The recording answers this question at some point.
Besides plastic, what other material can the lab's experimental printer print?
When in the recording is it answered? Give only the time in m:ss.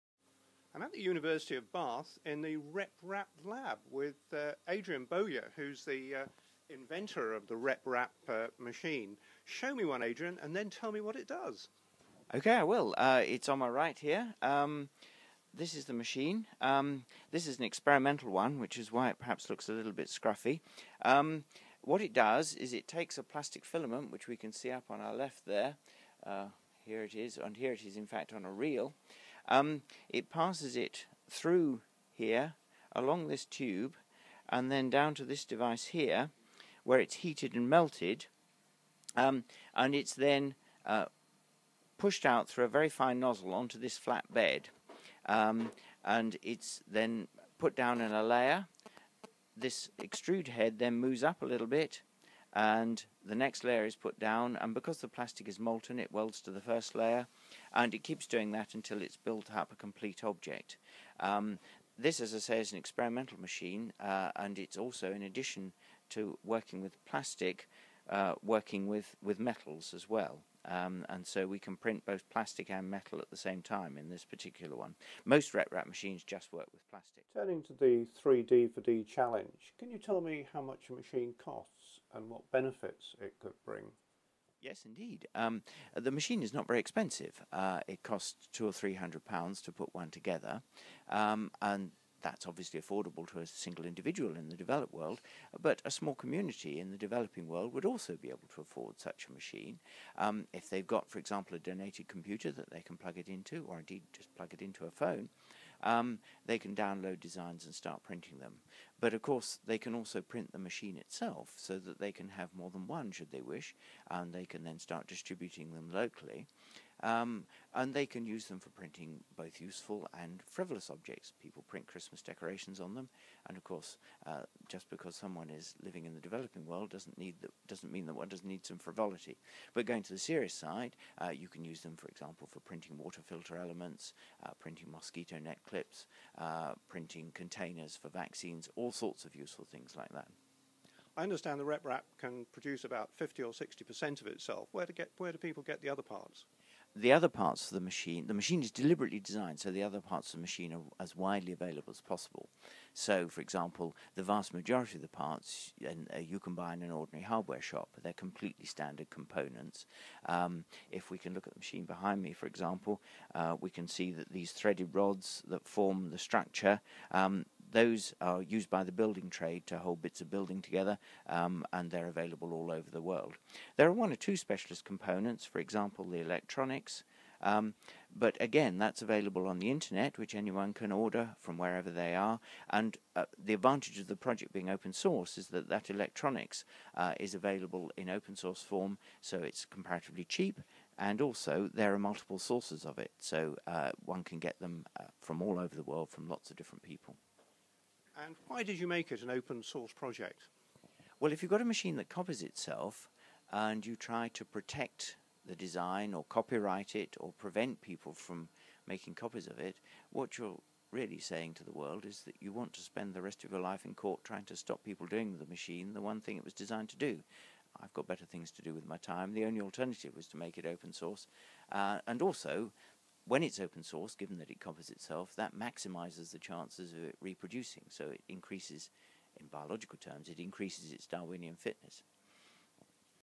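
1:09.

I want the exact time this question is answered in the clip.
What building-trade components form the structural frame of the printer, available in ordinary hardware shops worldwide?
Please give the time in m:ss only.
2:44.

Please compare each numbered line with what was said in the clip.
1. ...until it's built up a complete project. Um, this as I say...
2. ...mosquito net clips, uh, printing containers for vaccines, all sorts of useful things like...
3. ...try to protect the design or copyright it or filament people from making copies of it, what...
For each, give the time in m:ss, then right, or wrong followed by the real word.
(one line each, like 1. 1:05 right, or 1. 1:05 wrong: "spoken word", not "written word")
1. 0:58 wrong: "object", not "project"
2. 2:14 right
3. 3:23 wrong: "prevent", not "filament".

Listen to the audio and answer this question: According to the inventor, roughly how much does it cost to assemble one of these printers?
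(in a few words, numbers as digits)
£200 to £300.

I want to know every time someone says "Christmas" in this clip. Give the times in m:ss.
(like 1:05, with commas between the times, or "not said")
2:01.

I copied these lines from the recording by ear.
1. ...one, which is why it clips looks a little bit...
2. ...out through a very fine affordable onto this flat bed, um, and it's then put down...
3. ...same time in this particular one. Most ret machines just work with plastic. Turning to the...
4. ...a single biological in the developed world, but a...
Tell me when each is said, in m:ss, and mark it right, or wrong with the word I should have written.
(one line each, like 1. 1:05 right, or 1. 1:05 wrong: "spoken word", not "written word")
1. 0:18 wrong: "perhaps", not "clips"
2. 0:42 wrong: "nozzle", not "affordable"
3. 1:13 right
4. 1:33 wrong: "individual", not "biological".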